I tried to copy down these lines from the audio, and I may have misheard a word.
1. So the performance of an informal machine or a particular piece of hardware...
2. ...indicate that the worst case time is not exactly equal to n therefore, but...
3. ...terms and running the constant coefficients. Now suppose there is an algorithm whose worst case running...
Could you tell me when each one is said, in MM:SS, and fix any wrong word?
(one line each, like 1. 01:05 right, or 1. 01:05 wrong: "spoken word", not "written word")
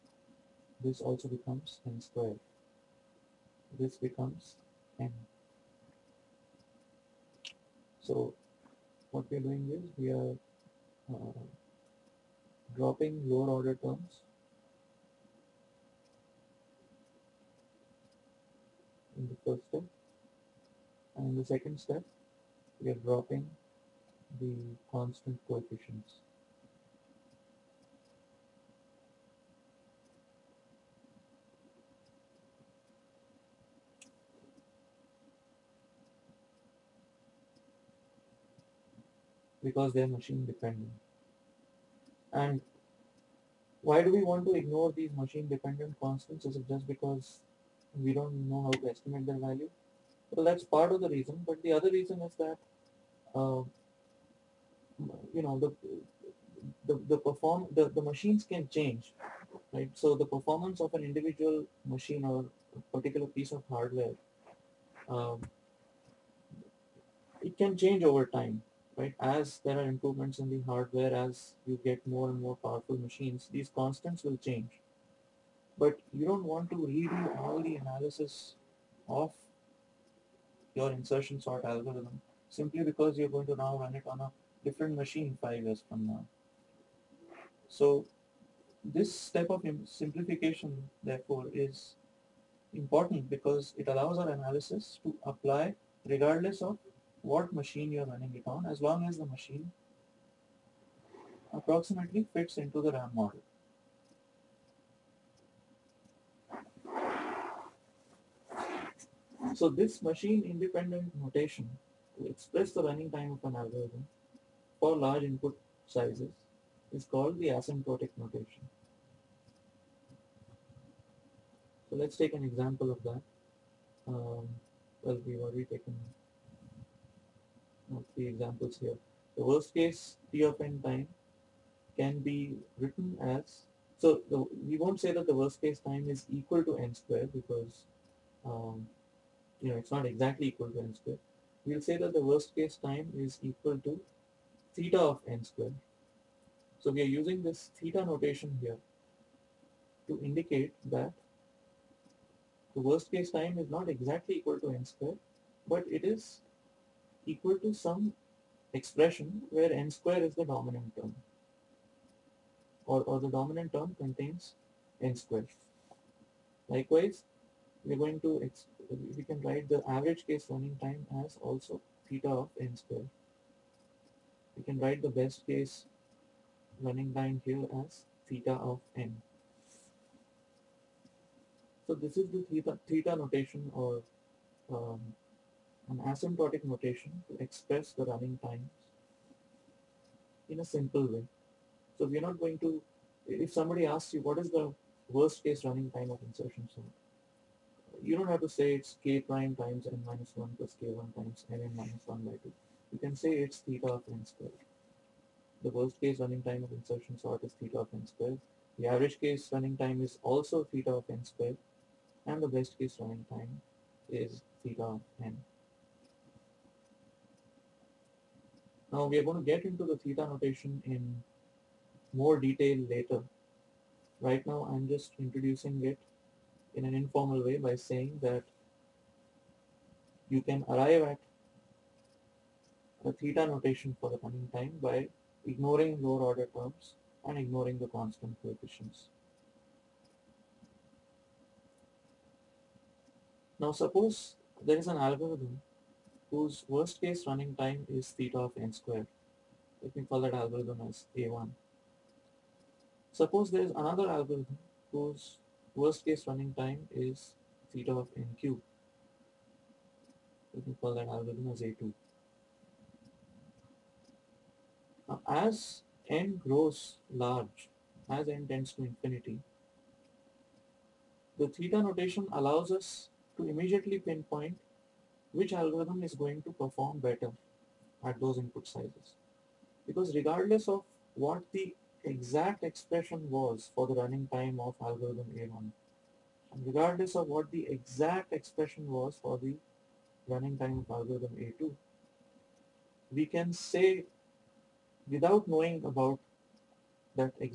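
1. 00:59 wrong: "individual", not "informal"
2. 02:30 wrong: "square", not "therefore"
3. 03:56 wrong: "ignoring", not "running".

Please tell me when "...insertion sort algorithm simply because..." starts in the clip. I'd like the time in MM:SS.
01:20.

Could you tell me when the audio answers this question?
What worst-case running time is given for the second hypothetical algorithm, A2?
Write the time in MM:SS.
04:17.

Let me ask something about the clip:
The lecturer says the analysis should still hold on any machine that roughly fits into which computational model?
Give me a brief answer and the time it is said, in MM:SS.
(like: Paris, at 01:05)
RAM model, at 01:42.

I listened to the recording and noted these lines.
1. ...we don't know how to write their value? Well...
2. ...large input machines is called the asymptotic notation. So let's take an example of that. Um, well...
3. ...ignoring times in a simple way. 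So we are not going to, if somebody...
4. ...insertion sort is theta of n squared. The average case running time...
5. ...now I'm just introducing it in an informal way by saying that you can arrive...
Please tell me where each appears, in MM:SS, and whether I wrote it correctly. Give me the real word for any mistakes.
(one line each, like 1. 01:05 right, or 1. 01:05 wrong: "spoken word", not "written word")
1. 00:47 wrong: "estimate", not "write"
2. 01:54 wrong: "sizes", not "machines"
3. 03:08 wrong: "running", not "ignoring"
4. 03:26 right
5. 03:44 right.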